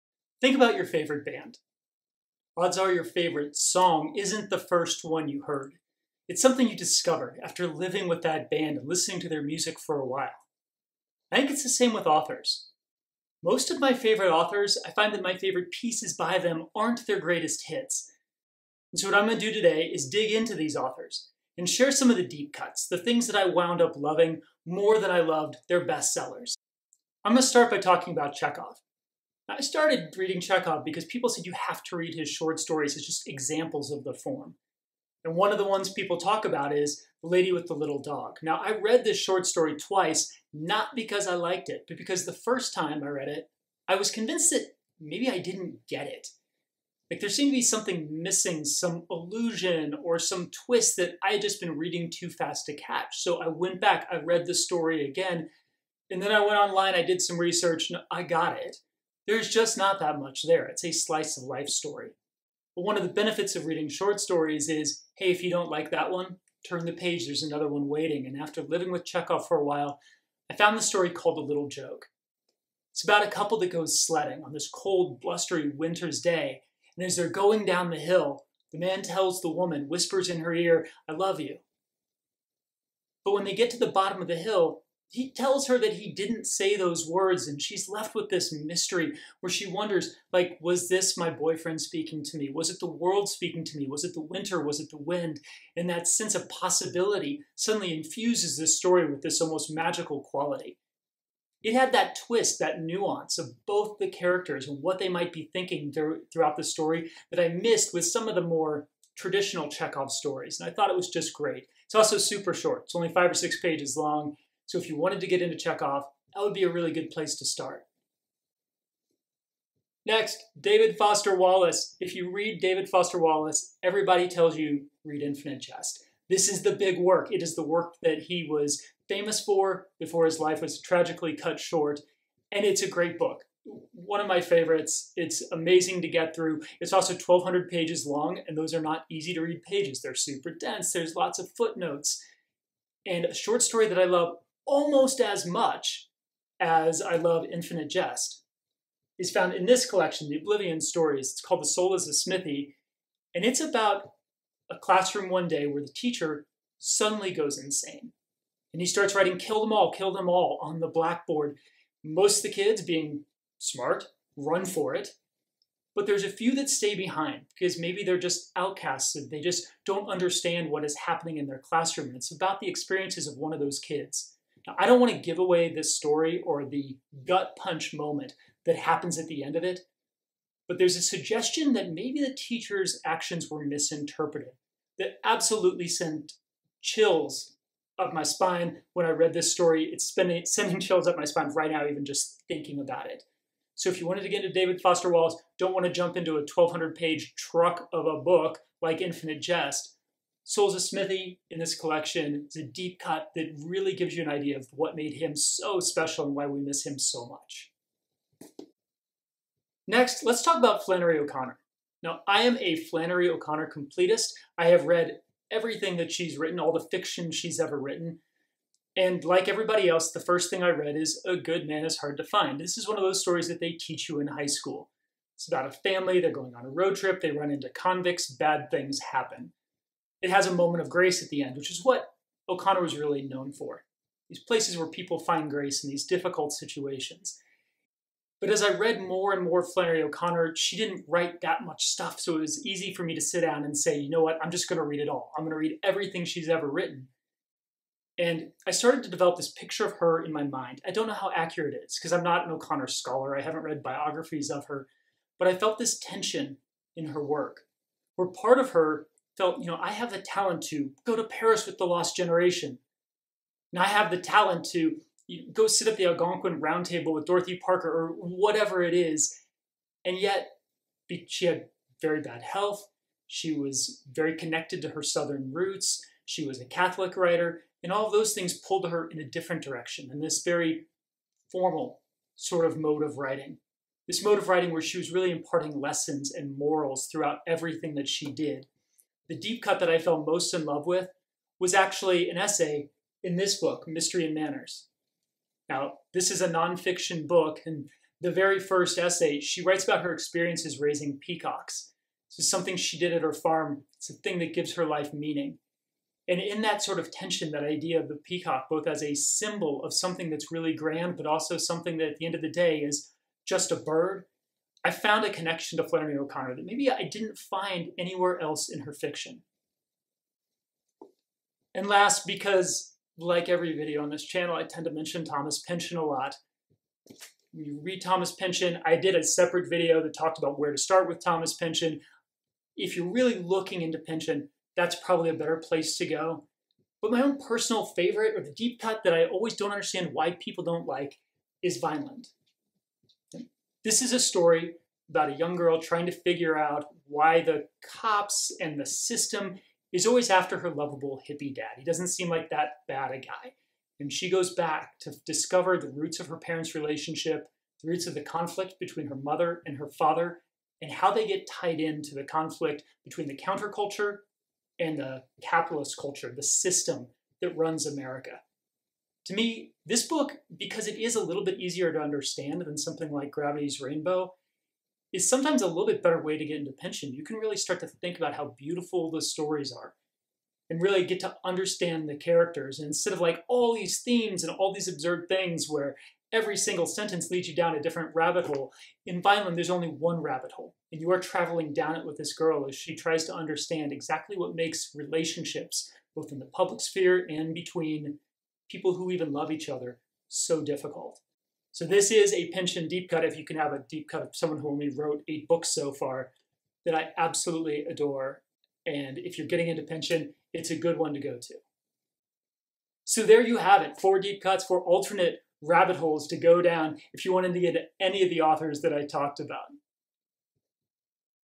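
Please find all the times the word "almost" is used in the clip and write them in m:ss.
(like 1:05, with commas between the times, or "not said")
1:39, 2:24.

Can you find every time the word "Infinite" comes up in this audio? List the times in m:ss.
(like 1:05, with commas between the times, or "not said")
2:05, 2:27, 3:19.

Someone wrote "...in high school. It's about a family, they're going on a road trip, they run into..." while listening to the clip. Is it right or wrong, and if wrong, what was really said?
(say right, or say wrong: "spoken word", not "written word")
right.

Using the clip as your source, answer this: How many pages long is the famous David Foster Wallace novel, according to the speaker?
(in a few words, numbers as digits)
1,200.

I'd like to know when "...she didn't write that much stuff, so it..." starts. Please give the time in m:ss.
4:00.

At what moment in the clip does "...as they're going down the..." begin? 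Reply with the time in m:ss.
1:17.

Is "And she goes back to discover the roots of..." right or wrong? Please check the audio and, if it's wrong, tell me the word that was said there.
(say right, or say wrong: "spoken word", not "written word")
right.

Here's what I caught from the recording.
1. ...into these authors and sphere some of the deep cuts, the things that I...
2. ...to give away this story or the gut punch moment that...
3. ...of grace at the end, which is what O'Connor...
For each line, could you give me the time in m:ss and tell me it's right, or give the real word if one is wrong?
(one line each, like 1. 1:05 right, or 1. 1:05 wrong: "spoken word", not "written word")
1. 0:20 wrong: "share", not "sphere"
2. 2:55 right
3. 3:50 right.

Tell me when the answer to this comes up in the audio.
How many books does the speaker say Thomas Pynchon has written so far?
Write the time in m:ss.
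6:45.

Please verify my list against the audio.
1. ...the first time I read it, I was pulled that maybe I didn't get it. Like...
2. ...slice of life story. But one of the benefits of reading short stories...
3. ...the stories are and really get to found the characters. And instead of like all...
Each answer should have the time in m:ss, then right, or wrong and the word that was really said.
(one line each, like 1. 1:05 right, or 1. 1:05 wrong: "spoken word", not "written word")
1. 0:42 wrong: "convinced", not "pulled"
2. 1:00 right
3. 6:19 wrong: "understand", not "found".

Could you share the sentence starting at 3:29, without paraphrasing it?
Next, let's talk about Flannery O'Connor.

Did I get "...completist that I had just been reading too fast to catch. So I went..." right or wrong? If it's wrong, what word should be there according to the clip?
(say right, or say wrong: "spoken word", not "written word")
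wrong: "twist", not "completist".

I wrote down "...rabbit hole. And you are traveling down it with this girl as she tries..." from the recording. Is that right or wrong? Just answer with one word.
right.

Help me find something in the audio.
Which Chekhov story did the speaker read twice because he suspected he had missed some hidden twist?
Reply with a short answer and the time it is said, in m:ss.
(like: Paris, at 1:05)
The Lady with the Little Dog, at 0:37.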